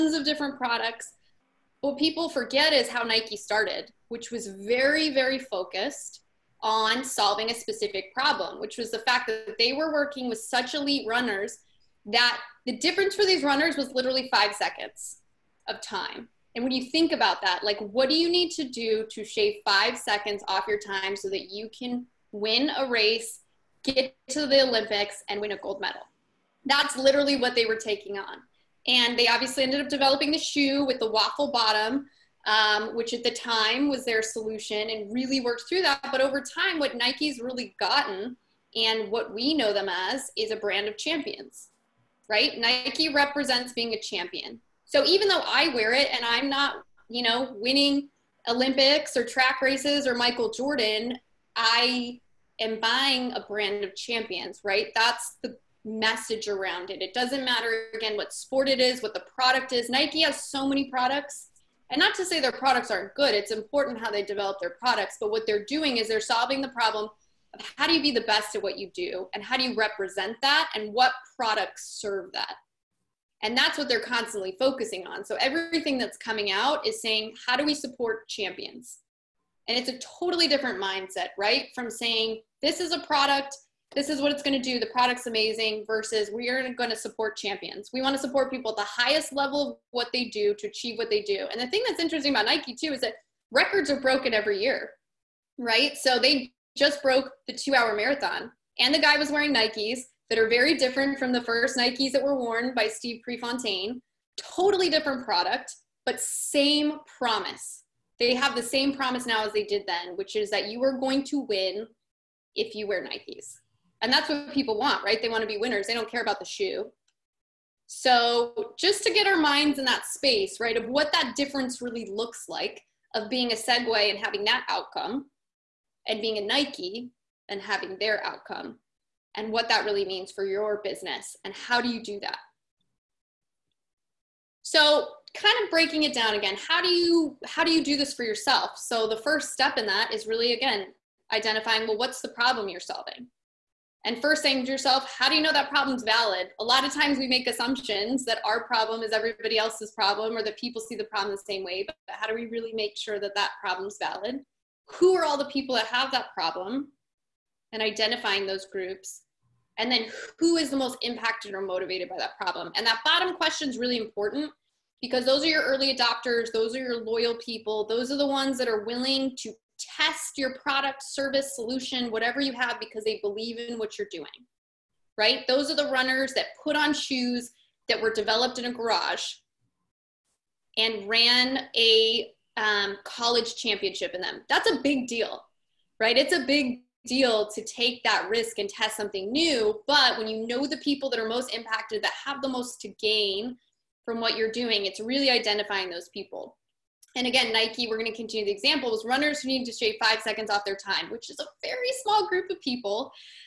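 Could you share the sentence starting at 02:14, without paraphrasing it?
So, kind of breaking it down again, how do you how do you do this for yourself?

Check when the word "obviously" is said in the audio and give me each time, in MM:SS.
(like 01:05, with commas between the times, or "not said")
00:29.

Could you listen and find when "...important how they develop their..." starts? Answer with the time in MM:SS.
01:03.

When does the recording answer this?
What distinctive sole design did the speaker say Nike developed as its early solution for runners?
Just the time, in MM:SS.
00:31.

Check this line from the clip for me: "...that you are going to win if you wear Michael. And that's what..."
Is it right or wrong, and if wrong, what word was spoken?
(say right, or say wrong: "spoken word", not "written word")
wrong: "Nikes", not "Michael".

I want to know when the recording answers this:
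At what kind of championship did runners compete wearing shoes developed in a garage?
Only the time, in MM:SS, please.
03:03.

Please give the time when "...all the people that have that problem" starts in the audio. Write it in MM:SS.
02:35.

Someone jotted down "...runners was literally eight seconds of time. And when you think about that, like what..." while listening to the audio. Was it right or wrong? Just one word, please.
wrong.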